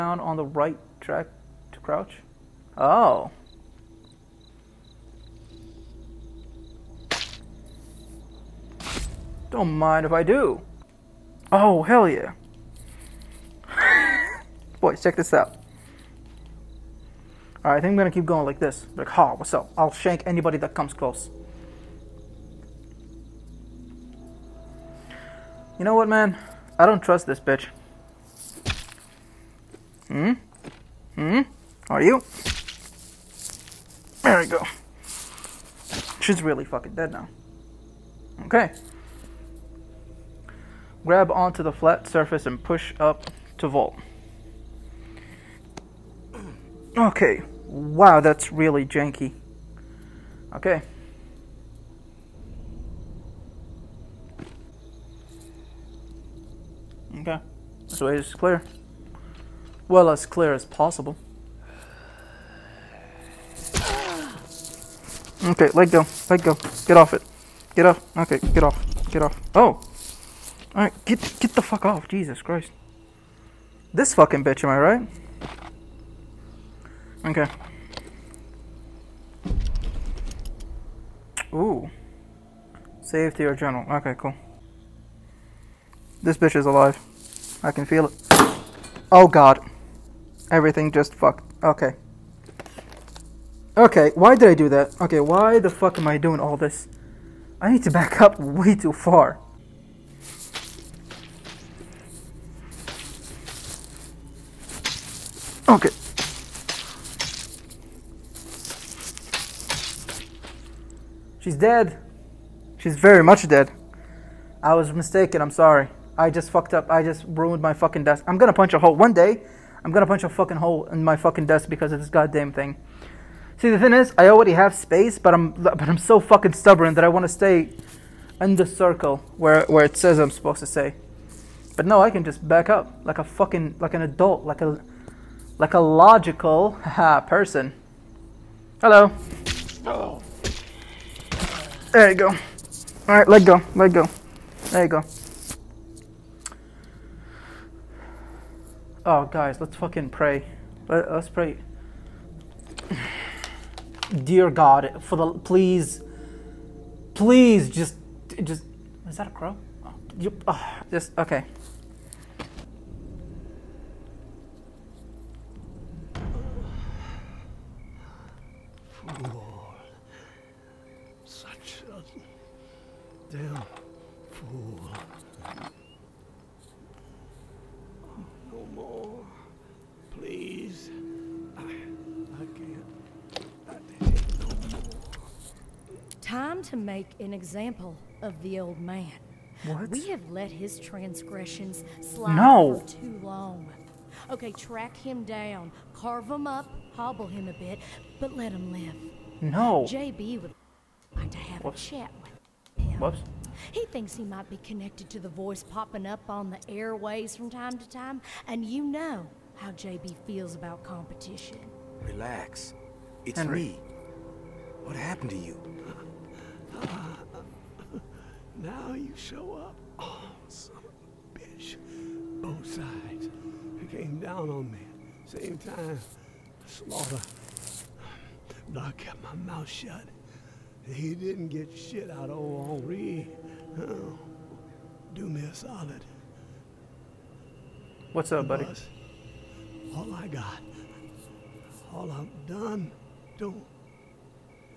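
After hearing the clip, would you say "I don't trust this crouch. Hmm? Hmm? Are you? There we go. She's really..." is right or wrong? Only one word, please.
wrong.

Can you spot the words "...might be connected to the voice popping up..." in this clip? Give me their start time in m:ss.
3:24.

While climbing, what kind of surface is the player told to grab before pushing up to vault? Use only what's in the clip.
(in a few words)
flat surface.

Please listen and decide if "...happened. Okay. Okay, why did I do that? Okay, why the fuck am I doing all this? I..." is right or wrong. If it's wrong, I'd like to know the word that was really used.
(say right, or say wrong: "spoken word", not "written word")
wrong: "fucked", not "happened".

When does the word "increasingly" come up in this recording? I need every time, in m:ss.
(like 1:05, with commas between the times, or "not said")
not said.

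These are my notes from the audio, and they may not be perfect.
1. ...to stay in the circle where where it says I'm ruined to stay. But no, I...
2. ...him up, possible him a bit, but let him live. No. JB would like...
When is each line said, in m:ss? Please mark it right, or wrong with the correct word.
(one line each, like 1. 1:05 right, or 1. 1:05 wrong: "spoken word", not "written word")
1. 2:07 wrong: "supposed", not "ruined"
2. 3:16 wrong: "hobble", not "possible".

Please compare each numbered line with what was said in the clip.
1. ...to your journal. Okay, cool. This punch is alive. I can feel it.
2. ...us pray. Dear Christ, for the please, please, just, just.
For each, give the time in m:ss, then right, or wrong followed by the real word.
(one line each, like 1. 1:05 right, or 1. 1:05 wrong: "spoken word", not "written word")
1. 1:23 wrong: "bitch", not "punch"
2. 2:31 wrong: "God", not "Christ".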